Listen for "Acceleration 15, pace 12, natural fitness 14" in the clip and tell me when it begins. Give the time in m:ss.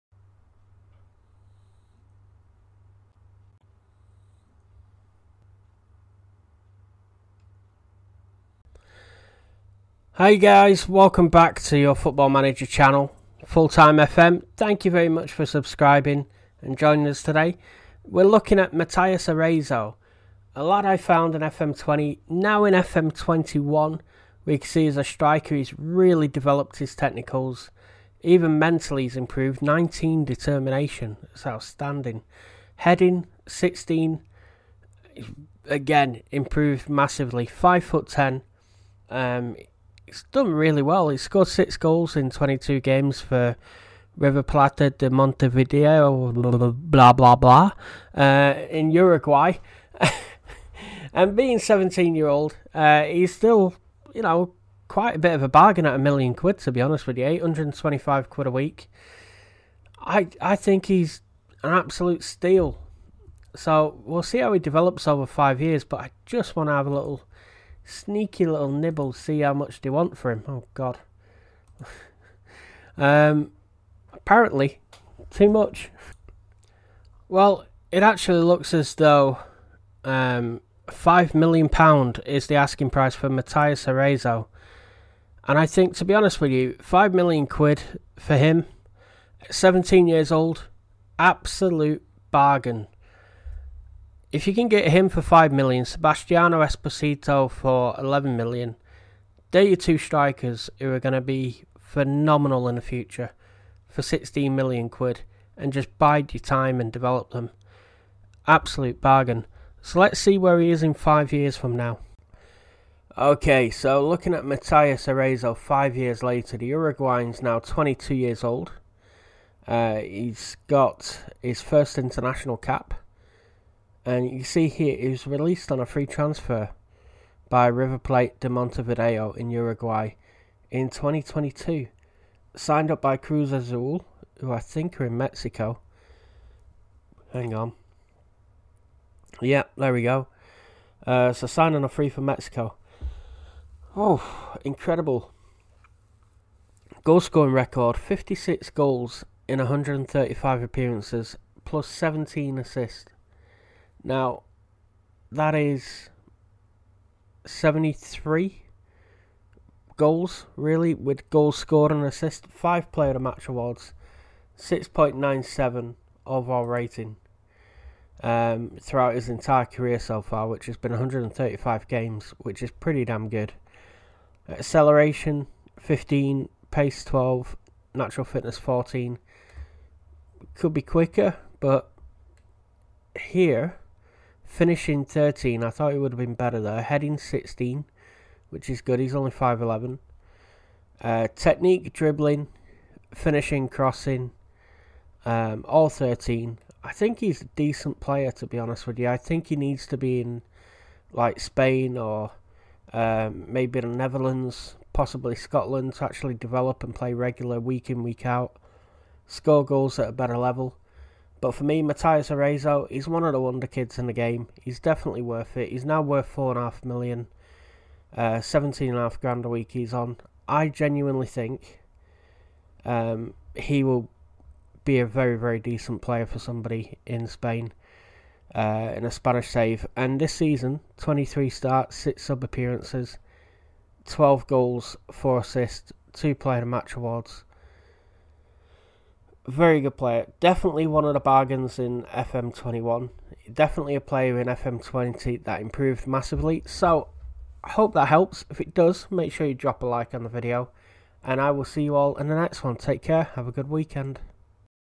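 2:54.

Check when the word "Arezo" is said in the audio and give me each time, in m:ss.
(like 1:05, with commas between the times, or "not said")
0:19, 1:23, 1:55, 3:32.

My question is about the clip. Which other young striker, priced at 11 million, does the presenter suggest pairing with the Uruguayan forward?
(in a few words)
Sebastiano Esposito.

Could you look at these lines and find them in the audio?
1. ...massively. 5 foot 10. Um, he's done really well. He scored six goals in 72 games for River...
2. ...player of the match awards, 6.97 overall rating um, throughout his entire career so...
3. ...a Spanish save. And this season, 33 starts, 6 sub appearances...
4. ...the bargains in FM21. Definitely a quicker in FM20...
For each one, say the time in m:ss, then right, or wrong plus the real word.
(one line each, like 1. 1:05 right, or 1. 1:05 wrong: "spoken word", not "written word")
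1. 0:36 wrong: "22", not "72"
2. 2:42 right
3. 3:49 wrong: "23", not "33"
4. 4:01 wrong: "player", not "quicker".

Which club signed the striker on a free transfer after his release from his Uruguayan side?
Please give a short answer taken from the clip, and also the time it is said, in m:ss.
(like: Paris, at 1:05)
Cruz Azul, at 2:13.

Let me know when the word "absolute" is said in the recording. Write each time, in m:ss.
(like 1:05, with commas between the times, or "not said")
1:01, 1:31, 1:48.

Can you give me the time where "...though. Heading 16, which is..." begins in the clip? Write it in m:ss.
3:06.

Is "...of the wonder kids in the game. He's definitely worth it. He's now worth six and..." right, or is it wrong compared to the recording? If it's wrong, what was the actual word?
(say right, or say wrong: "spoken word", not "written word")
wrong: "four", not "six".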